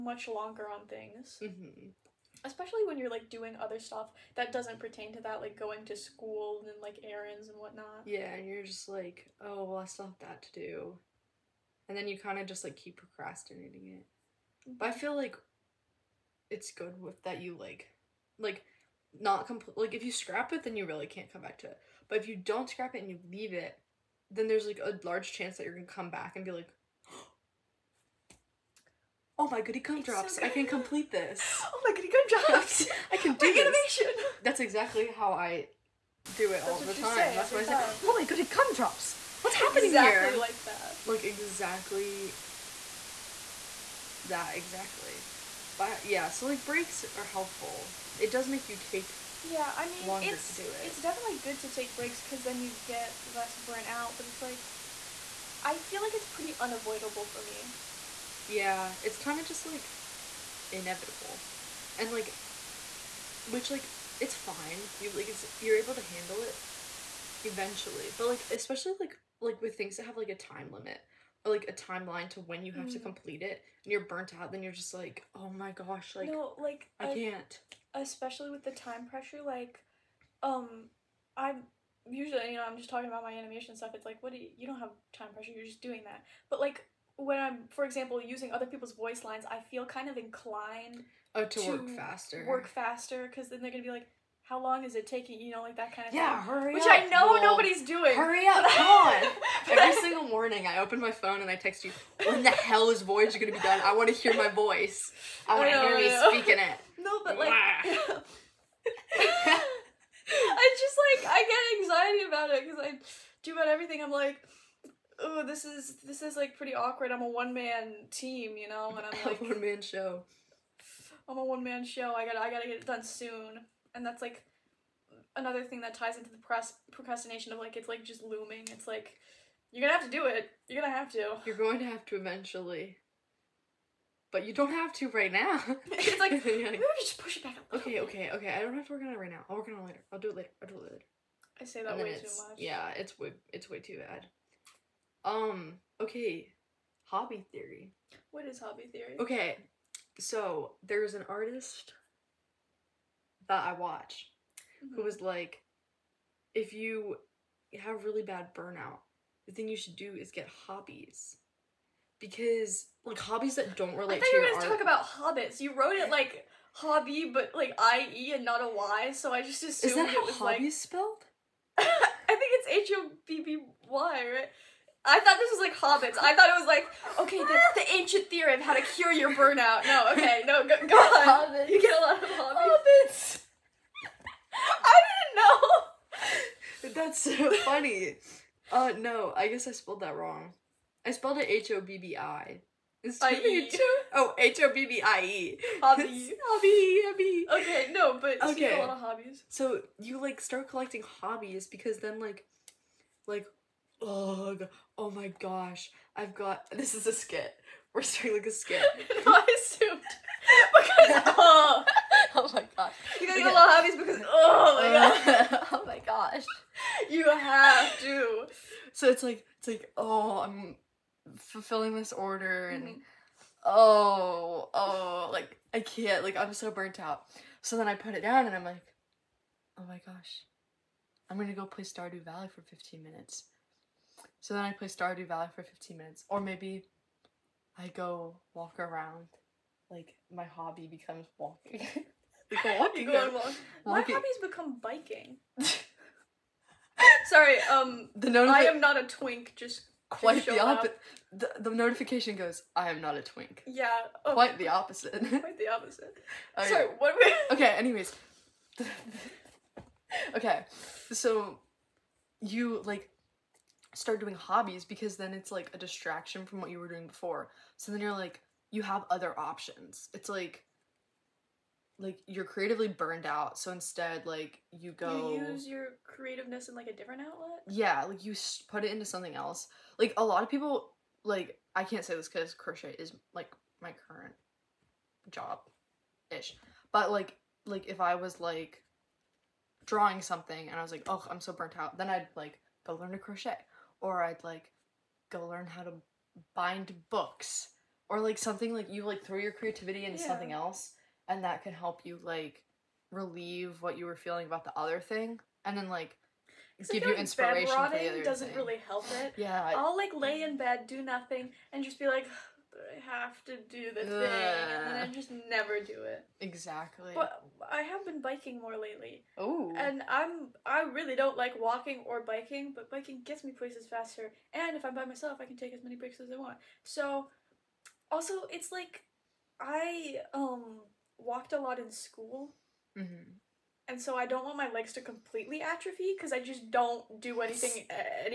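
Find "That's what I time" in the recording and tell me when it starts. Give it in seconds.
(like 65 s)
37 s.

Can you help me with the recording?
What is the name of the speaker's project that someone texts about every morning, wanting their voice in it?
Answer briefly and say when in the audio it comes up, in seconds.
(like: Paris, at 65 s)
Voyager, at 103 s.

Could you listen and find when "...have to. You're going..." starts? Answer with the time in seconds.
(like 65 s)
130 s.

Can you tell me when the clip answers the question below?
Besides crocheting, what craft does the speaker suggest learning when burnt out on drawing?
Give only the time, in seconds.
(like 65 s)
296 s.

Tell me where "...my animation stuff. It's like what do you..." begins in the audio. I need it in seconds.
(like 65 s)
83 s.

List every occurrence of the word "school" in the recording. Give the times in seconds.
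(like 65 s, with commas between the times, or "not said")
5 s, 331 s.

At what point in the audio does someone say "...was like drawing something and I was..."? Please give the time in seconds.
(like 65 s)
288 s.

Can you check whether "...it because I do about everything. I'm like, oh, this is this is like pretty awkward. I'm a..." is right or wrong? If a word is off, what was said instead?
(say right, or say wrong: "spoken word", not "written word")
right.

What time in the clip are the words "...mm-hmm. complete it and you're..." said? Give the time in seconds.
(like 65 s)
72 s.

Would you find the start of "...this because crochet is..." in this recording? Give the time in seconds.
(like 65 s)
282 s.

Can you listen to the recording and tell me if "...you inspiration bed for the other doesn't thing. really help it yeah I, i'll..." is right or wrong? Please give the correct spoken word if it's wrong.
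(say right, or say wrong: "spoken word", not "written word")
right.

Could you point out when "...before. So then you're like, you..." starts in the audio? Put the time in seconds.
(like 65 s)
267 s.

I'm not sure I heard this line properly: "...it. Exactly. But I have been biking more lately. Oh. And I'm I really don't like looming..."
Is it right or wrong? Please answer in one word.
wrong.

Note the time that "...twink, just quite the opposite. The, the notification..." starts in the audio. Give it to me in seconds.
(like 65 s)
249 s.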